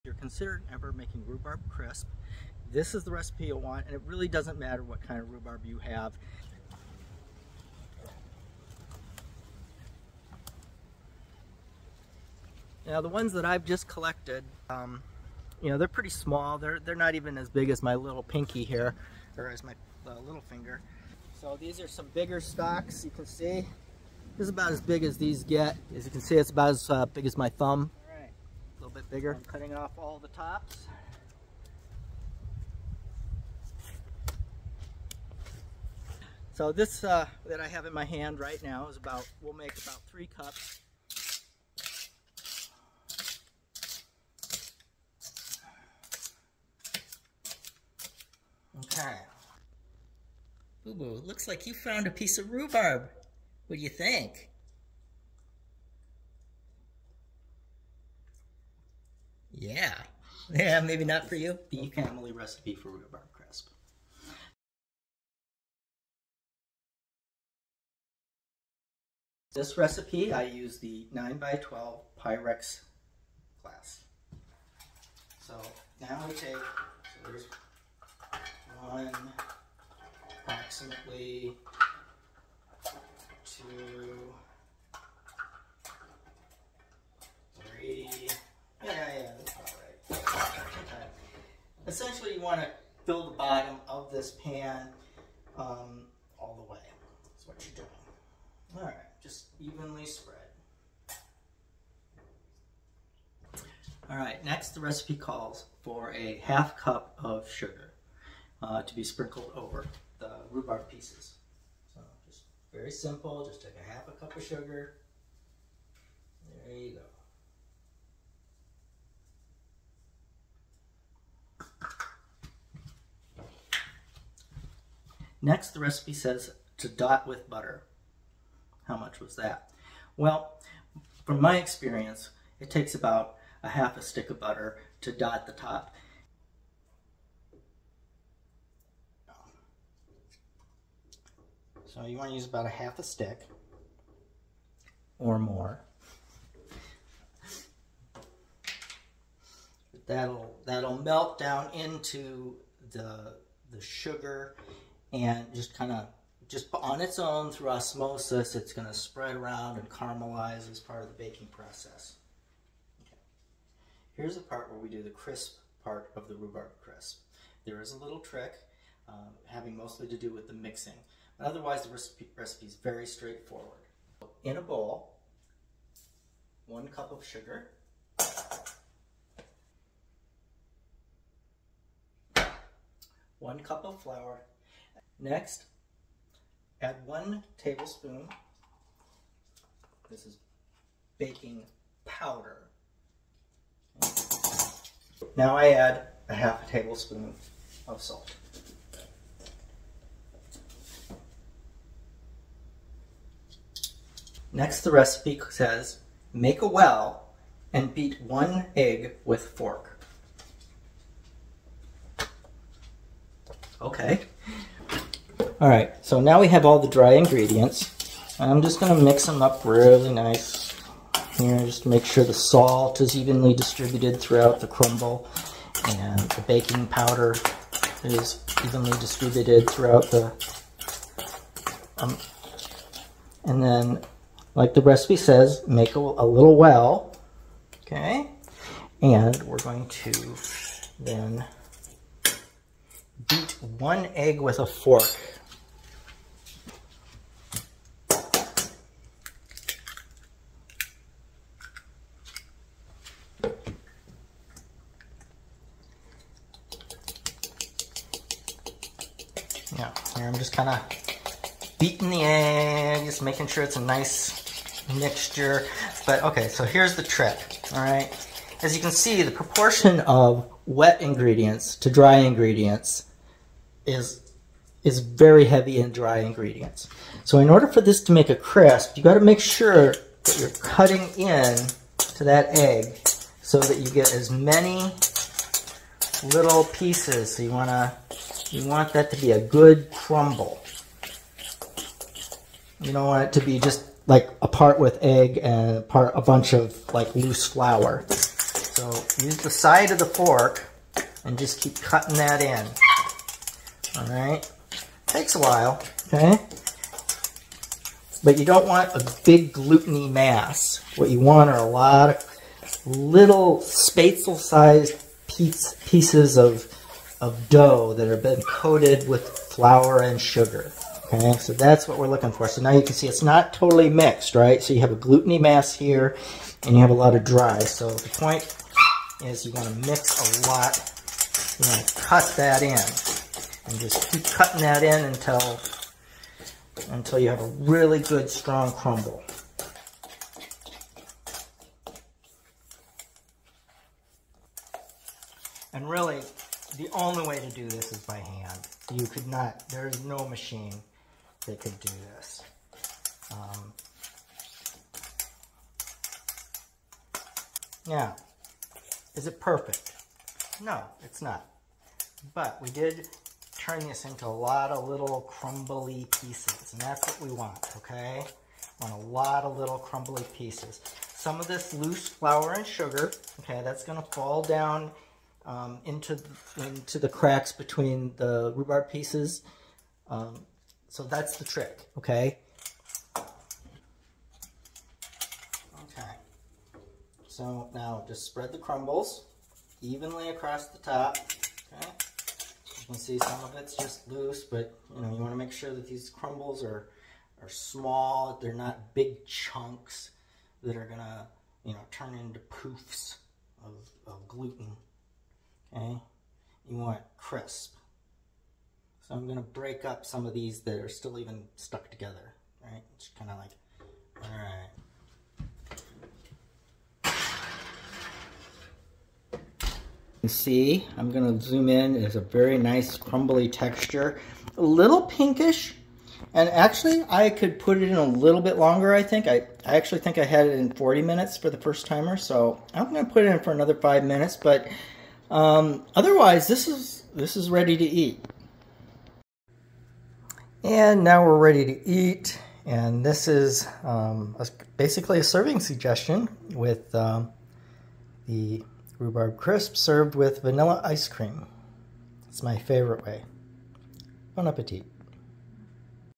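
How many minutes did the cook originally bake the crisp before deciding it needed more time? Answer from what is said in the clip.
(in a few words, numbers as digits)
40 minutes.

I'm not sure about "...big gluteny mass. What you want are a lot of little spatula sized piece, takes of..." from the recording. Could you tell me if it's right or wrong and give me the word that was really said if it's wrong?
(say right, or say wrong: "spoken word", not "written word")
wrong: "pieces", not "takes".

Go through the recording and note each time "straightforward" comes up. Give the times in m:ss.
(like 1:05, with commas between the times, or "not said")
2:53.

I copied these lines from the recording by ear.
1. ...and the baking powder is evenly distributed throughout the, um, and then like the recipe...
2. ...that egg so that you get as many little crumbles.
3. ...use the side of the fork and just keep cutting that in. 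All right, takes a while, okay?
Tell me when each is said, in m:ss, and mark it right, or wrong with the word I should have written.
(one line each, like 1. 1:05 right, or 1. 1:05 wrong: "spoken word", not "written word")
1. 3:45 right
2. 4:42 wrong: "pieces", not "crumbles"
3. 4:59 right.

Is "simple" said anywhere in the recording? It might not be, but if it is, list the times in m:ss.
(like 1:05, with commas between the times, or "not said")
1:52.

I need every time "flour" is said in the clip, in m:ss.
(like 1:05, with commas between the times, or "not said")
3:04, 4:57, 5:19, 6:12.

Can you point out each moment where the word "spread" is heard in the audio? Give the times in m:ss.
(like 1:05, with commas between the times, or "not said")
1:40, 2:38, 6:28.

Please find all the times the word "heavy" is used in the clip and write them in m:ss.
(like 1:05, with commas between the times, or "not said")
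4:35.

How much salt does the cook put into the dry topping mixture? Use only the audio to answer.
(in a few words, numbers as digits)
Half a tablespoon.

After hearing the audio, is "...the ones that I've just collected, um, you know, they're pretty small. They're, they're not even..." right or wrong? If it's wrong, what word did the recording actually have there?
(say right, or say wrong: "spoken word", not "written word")
right.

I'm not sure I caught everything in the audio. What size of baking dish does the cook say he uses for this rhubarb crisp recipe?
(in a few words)
9x12 Pyrex glass.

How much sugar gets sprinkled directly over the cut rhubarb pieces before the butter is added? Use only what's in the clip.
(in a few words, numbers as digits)
Half cup.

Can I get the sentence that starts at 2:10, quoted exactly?
Well, from my experience, it takes about a half a stick of butter to dot the top.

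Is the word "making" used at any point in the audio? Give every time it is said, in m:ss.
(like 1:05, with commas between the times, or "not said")
0:00, 4:23.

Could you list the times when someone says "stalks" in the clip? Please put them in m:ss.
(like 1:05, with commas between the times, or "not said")
0:22.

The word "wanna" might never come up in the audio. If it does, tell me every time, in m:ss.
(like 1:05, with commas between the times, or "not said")
6:35.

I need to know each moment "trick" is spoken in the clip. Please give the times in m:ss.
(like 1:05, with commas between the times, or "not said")
2:48, 4:27, 6:21.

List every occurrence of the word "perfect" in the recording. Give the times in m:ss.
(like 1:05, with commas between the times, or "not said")
5:59.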